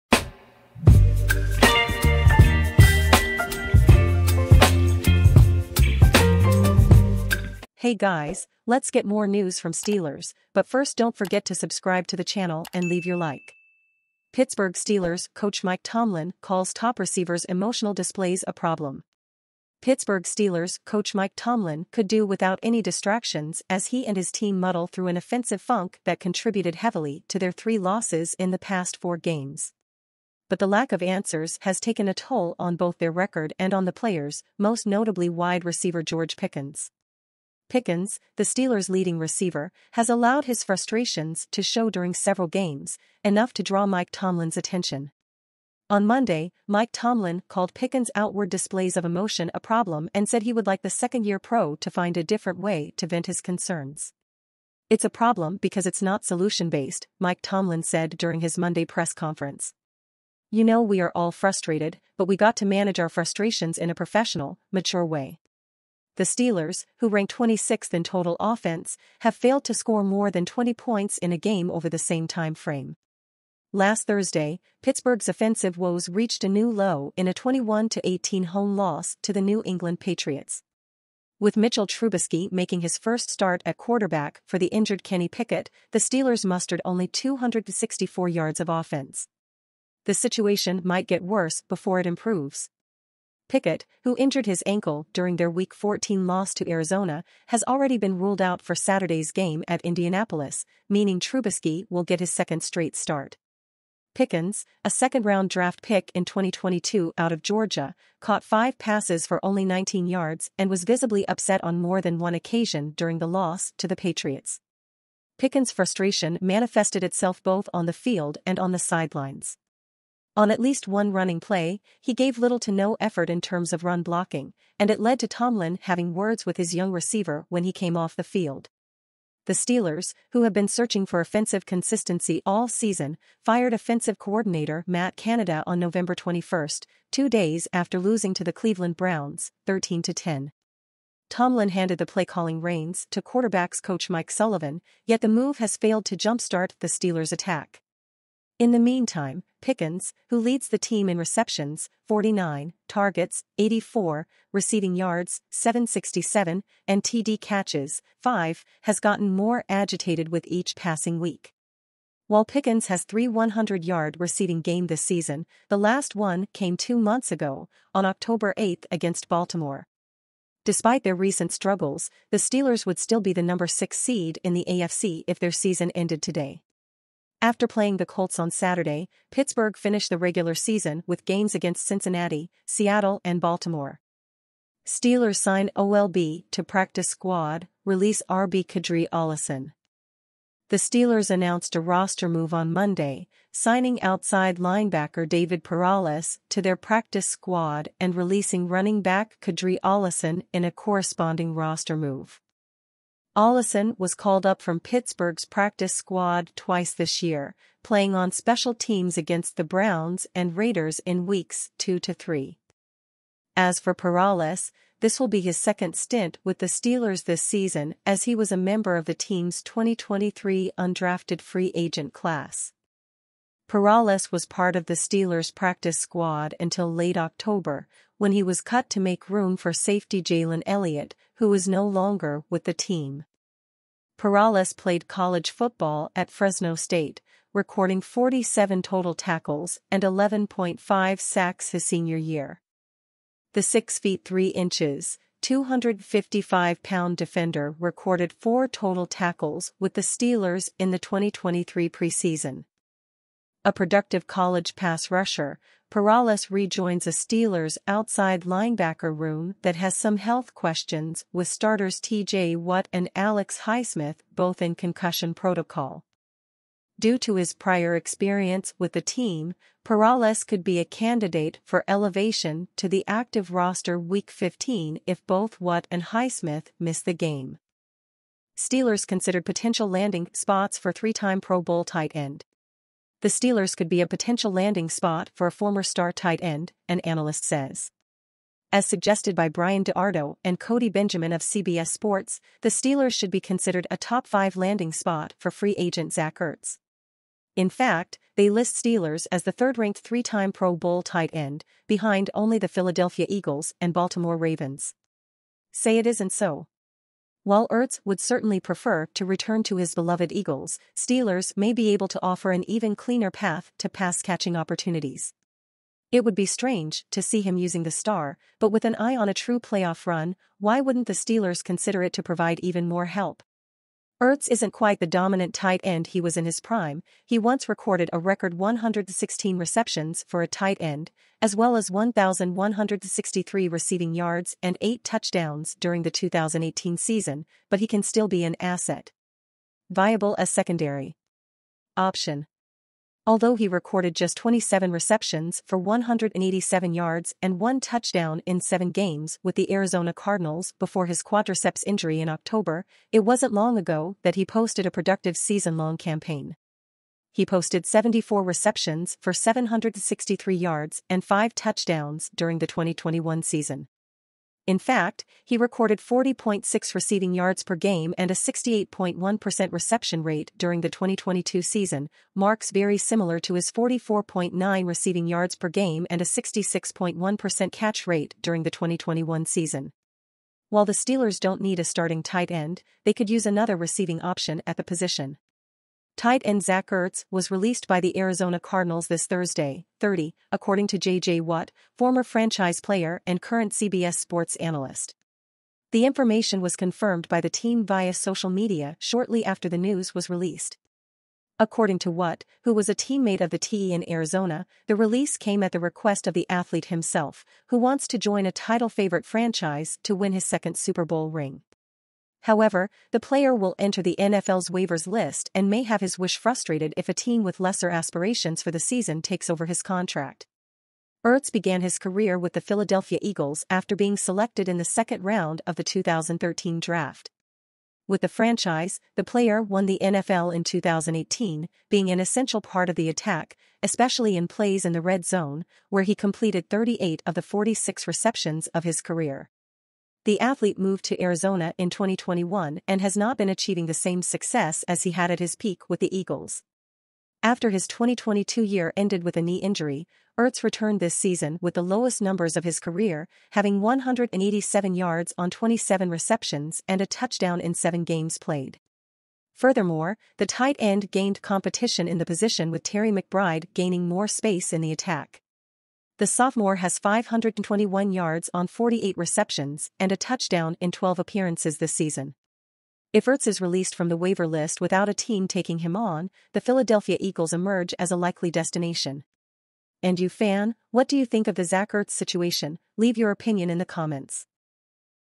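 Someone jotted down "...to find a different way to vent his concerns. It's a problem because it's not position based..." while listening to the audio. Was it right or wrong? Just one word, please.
wrong.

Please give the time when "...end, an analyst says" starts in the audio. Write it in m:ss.
4:46.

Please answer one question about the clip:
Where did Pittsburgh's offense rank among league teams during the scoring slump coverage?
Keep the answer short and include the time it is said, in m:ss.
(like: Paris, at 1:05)
26th, at 1:07.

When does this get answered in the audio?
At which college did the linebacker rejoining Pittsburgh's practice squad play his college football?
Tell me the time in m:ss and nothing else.
3:56.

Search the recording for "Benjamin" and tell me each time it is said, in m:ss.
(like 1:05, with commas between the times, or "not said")
4:50.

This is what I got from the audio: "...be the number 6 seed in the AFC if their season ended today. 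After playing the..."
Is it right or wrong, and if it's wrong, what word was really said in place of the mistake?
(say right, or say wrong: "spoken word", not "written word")
right.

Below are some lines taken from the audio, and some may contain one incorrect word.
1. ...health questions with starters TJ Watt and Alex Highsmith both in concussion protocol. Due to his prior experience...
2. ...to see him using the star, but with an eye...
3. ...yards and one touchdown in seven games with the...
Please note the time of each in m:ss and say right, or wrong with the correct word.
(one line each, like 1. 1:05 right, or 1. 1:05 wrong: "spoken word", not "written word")
1. 4:20 right
2. 5:17 right
3. 5:46 right.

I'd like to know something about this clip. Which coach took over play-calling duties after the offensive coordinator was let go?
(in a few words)
Mike Sullivan.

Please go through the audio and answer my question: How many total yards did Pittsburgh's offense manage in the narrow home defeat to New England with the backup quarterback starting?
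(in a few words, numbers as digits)
264.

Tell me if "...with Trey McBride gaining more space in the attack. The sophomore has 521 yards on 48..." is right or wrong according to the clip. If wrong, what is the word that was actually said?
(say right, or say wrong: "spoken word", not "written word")
right.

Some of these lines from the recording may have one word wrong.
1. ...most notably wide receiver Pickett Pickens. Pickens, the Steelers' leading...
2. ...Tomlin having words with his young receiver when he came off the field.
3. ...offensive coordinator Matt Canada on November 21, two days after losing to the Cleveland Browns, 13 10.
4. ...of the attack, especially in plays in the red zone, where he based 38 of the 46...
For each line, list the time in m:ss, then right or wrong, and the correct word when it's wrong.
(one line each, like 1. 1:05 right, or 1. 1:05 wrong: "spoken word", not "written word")
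1. 0:34 wrong: "George", not "Pickett"
2. 2:05 right
3. 2:13 right
4. 7:12 wrong: "completed", not "based".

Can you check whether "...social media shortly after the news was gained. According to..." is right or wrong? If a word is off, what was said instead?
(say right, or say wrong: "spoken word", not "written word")
wrong: "released", not "gained".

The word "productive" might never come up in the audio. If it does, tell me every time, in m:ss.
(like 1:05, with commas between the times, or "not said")
4:13, 5:54.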